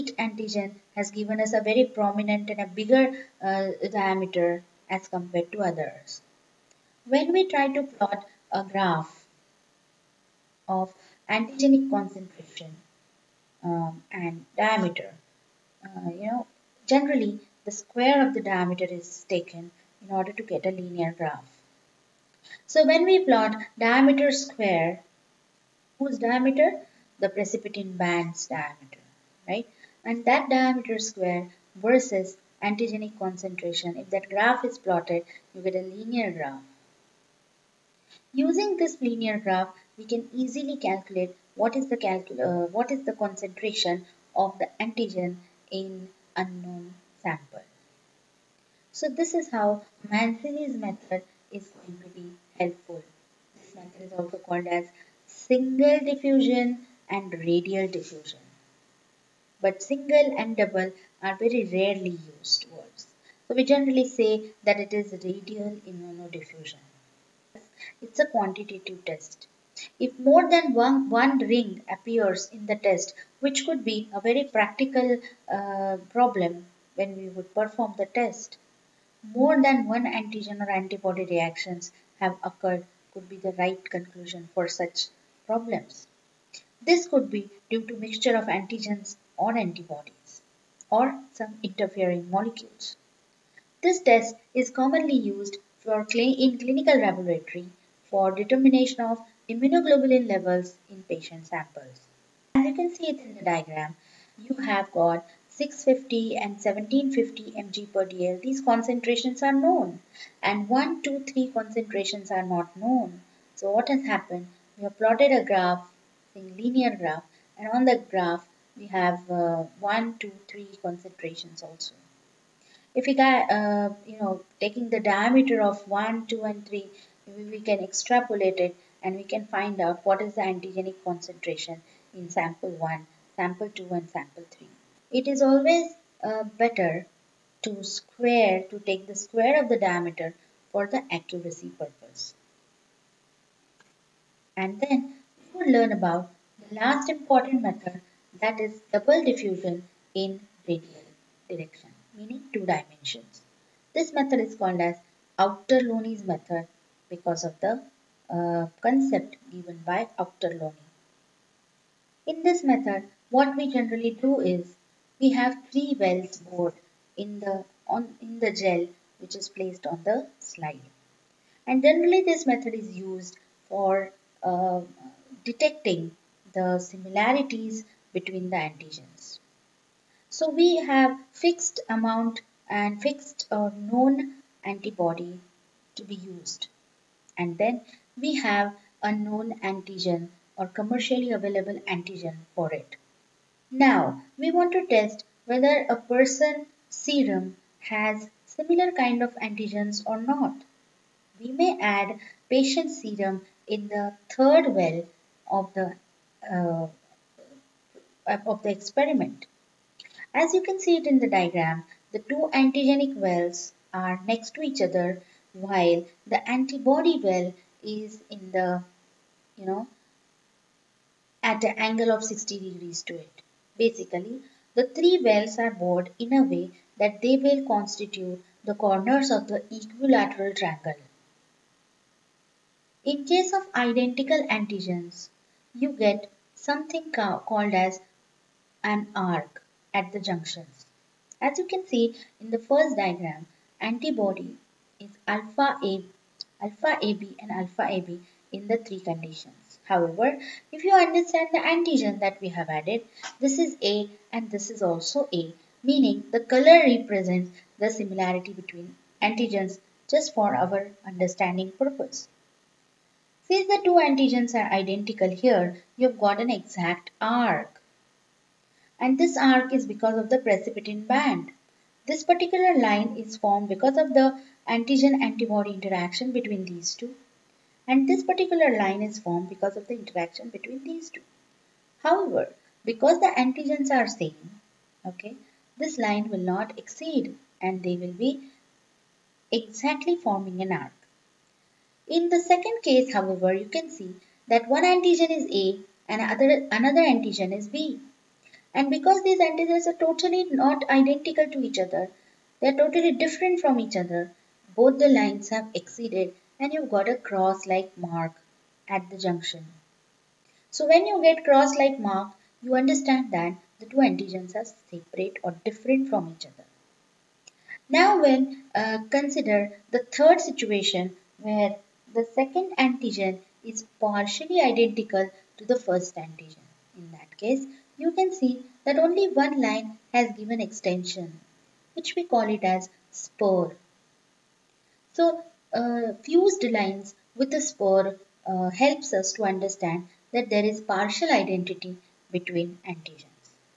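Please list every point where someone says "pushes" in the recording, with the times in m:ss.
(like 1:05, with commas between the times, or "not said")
not said.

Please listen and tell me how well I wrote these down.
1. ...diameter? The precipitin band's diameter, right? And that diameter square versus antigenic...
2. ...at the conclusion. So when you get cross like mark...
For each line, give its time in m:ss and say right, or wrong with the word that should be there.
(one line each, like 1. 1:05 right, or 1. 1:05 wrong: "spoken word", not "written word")
1. 0:26 right
2. 5:08 wrong: "junction", not "conclusion".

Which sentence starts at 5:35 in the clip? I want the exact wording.
So uh, fused lines with a spur uh, helps us to understand that there is partial identity between antigens.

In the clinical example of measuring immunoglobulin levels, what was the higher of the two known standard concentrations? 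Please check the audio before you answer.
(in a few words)
1750 mg per dl.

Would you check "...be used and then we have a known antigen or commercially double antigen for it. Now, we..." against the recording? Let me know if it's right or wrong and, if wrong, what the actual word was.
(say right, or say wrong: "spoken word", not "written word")
wrong: "available", not "double".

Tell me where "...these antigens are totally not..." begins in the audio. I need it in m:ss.
4:59.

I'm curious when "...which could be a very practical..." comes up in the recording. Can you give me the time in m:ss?
1:13.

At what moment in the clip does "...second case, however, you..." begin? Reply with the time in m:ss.
4:52.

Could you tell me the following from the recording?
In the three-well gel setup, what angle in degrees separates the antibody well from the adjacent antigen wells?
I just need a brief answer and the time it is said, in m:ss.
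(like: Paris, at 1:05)
60 degrees, at 3:42.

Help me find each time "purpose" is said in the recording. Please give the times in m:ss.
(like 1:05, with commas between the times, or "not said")
2:21, 4:21.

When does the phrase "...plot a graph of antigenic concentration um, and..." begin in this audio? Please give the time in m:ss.
0:07.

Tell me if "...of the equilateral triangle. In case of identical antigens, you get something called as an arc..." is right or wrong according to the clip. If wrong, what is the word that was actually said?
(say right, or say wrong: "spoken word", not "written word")
right.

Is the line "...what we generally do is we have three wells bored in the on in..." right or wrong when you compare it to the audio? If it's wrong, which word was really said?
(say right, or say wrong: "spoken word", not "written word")
right.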